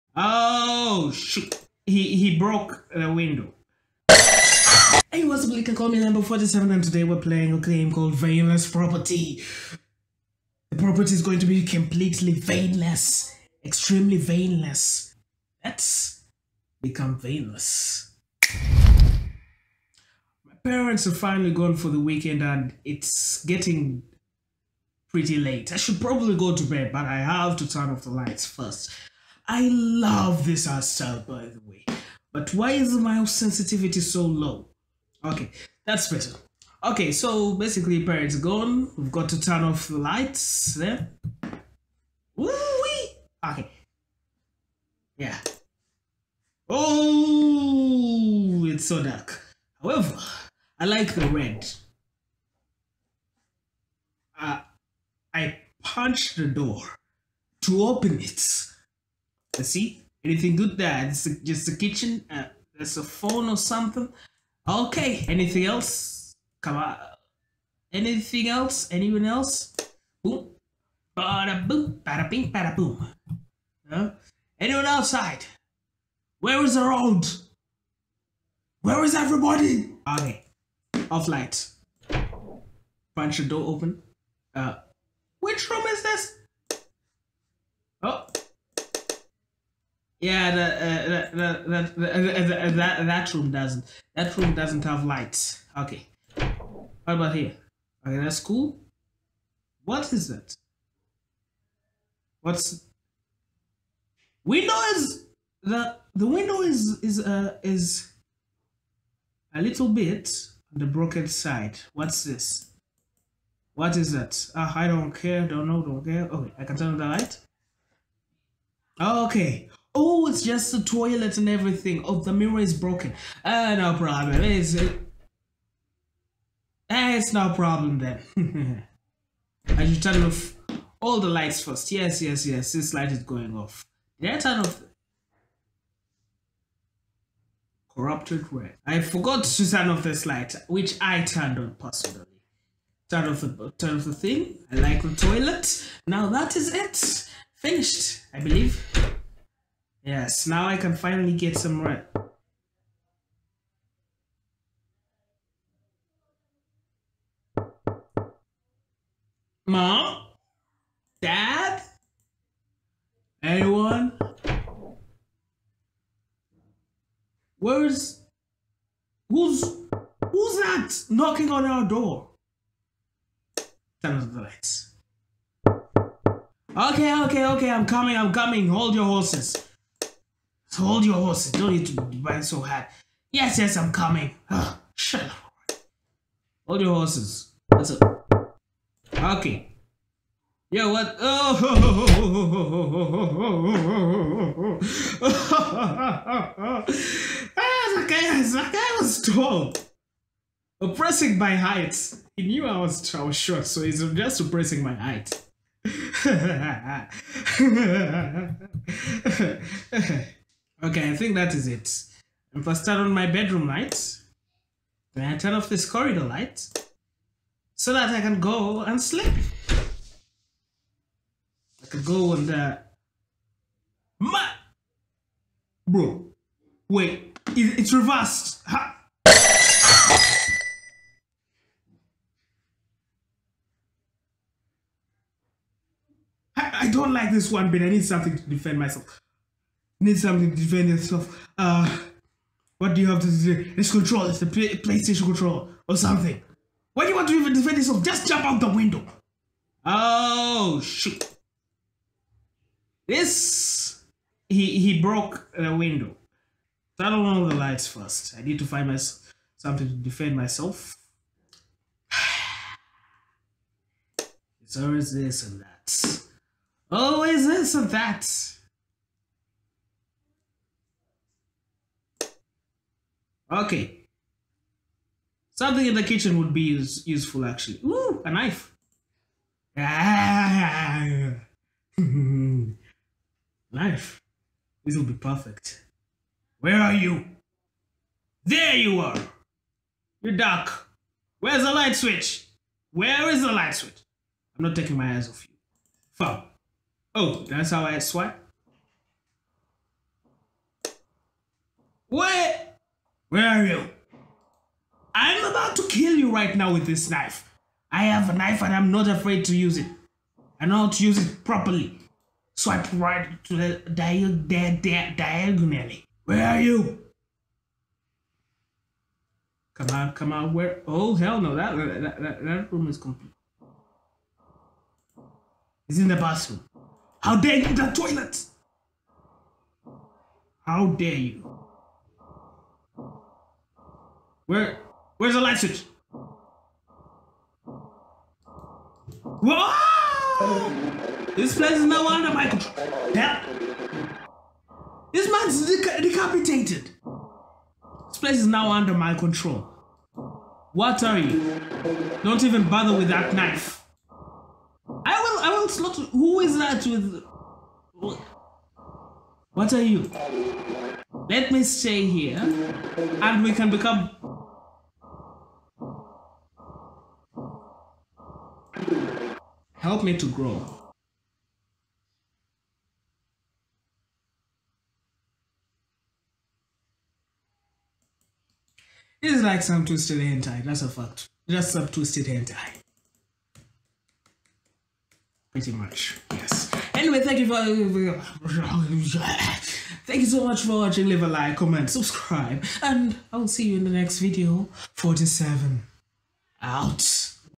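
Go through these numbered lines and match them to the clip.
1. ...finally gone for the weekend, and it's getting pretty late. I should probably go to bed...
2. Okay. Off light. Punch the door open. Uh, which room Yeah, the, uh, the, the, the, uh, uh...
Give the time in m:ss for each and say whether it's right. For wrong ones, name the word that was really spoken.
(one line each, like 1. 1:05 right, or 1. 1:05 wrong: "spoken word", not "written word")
1. 0:21 right
2. 1:20 right.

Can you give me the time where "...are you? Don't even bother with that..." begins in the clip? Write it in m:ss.
5:51.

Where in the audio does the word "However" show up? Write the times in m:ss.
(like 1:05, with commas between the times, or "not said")
0:49.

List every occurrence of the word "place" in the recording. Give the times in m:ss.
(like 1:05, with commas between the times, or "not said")
5:41, 5:48.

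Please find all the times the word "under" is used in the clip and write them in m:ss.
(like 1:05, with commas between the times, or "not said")
5:42, 5:48.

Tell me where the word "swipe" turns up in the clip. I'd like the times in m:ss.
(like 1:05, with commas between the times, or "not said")
4:57, 5:12.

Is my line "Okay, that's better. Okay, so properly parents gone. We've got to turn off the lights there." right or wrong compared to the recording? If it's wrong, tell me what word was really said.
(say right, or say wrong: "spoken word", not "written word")
wrong: "basically", not "properly".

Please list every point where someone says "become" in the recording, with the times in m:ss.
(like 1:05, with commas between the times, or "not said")
0:16, 6:03.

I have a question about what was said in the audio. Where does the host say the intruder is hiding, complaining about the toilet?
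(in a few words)
The bathroom.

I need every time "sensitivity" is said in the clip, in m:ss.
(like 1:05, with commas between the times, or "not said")
0:33.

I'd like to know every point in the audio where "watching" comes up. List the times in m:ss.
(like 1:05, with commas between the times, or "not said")
6:30.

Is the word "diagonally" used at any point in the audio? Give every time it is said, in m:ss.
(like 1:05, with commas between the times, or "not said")
5:15.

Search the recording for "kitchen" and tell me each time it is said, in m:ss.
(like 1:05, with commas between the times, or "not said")
1:01, 4:36.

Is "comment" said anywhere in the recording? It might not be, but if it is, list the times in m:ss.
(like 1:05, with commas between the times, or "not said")
6:31.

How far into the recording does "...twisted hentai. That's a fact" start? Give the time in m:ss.
6:19.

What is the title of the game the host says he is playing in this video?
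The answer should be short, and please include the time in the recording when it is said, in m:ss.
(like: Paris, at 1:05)
Veinless Property, at 0:08.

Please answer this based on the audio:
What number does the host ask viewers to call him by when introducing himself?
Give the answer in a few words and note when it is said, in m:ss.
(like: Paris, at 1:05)
47, at 0:05.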